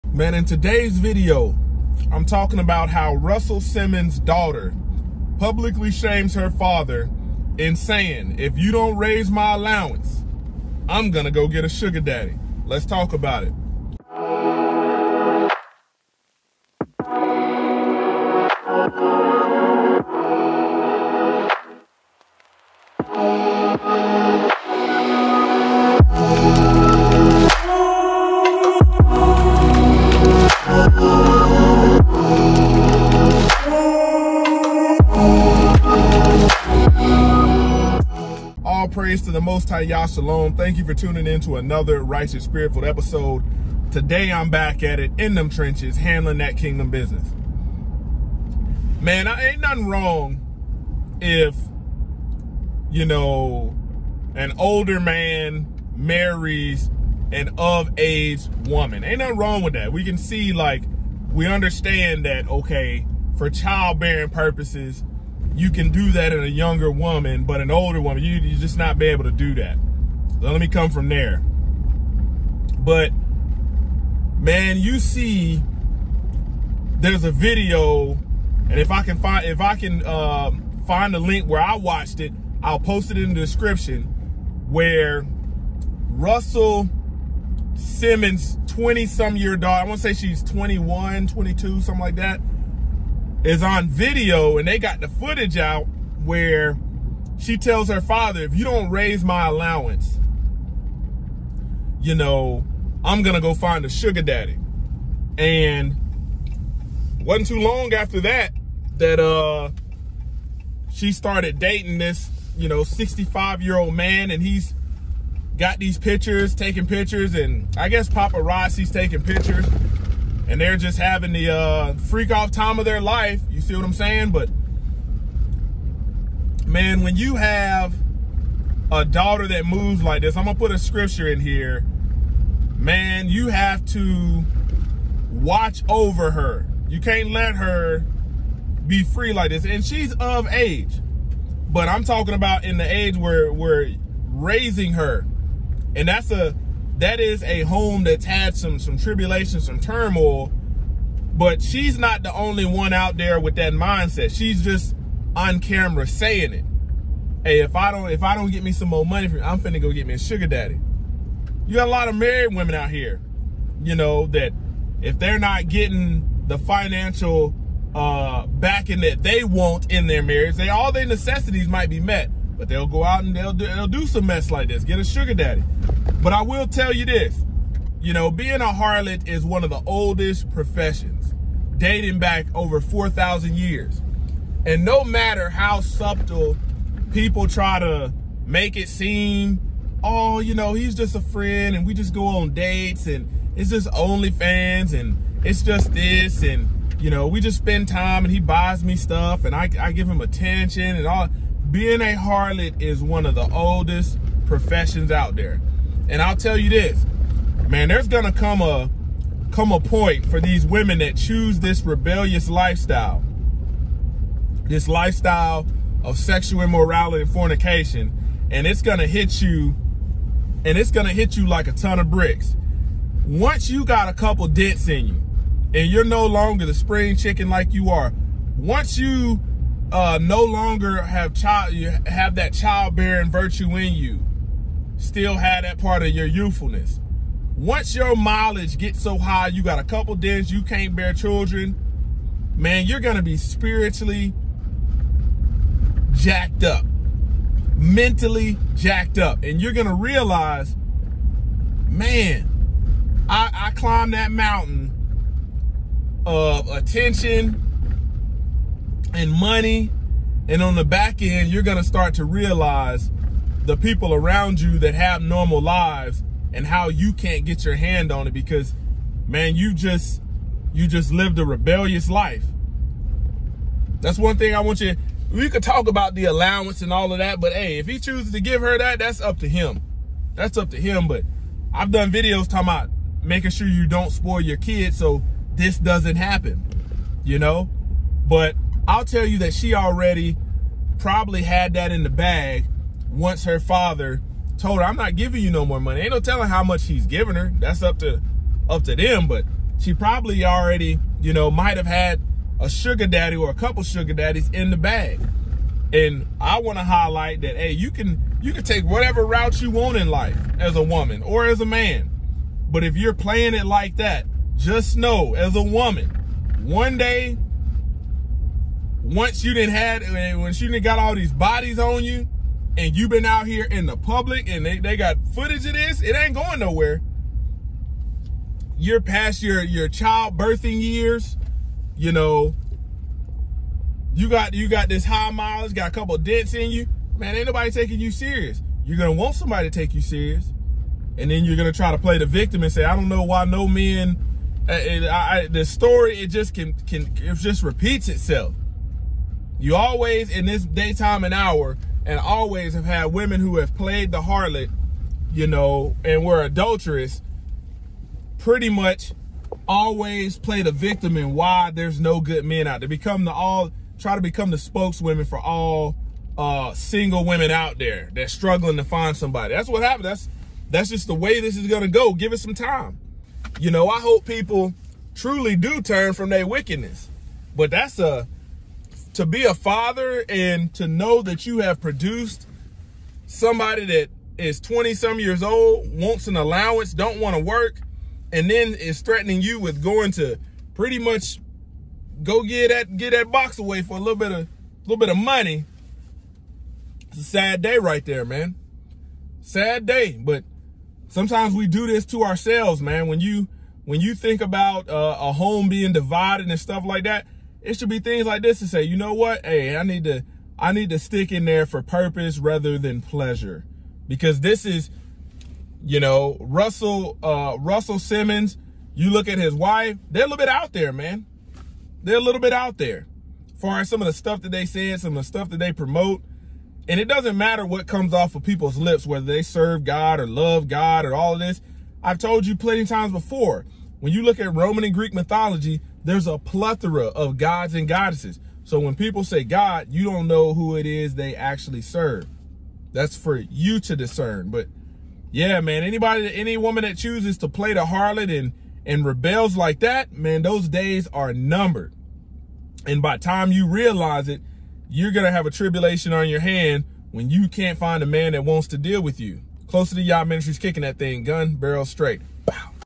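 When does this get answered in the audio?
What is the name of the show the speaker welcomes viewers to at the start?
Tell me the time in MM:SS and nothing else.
00:42.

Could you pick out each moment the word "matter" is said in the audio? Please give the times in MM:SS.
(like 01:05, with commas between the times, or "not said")
03:05, 07:07.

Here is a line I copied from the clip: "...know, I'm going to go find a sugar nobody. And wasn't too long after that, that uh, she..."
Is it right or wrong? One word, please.
wrong.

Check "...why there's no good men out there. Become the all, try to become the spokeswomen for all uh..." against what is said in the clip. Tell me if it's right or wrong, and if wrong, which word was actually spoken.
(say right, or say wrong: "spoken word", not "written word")
right.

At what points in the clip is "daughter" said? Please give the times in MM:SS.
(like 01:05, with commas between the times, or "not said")
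00:04, 01:29, 02:09.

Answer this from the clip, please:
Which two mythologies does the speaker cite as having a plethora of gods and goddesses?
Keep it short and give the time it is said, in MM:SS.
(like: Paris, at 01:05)
Roman and Greek, at 07:14.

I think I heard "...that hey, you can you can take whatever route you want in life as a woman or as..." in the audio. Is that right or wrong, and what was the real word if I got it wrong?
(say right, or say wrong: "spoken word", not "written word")
right.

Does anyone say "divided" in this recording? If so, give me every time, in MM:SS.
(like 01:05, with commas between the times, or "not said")
06:45.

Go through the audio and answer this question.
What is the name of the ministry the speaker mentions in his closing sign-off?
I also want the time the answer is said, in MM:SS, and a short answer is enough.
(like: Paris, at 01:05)
Closer to Yah ministries, at 07:39.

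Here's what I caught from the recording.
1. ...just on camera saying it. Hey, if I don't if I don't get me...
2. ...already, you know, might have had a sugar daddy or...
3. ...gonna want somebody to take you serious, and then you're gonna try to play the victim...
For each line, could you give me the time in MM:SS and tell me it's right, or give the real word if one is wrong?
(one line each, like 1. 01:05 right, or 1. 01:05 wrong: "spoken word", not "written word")
1. 02:34 right
2. 05:00 right
3. 05:38 right.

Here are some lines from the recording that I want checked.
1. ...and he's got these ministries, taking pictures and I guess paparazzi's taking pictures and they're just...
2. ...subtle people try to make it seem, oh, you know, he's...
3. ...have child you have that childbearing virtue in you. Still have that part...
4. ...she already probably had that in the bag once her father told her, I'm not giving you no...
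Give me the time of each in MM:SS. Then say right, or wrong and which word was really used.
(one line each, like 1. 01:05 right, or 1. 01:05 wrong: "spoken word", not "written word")
1. 01:54 wrong: "pictures", not "ministries"
2. 03:05 right
3. 03:51 right
4. 04:49 right.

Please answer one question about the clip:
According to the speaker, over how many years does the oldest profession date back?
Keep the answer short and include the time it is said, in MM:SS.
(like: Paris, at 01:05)
4,000, at 03:02.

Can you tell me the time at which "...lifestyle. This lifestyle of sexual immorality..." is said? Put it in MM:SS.
03:32.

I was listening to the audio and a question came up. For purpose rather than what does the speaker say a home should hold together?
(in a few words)
pleasure.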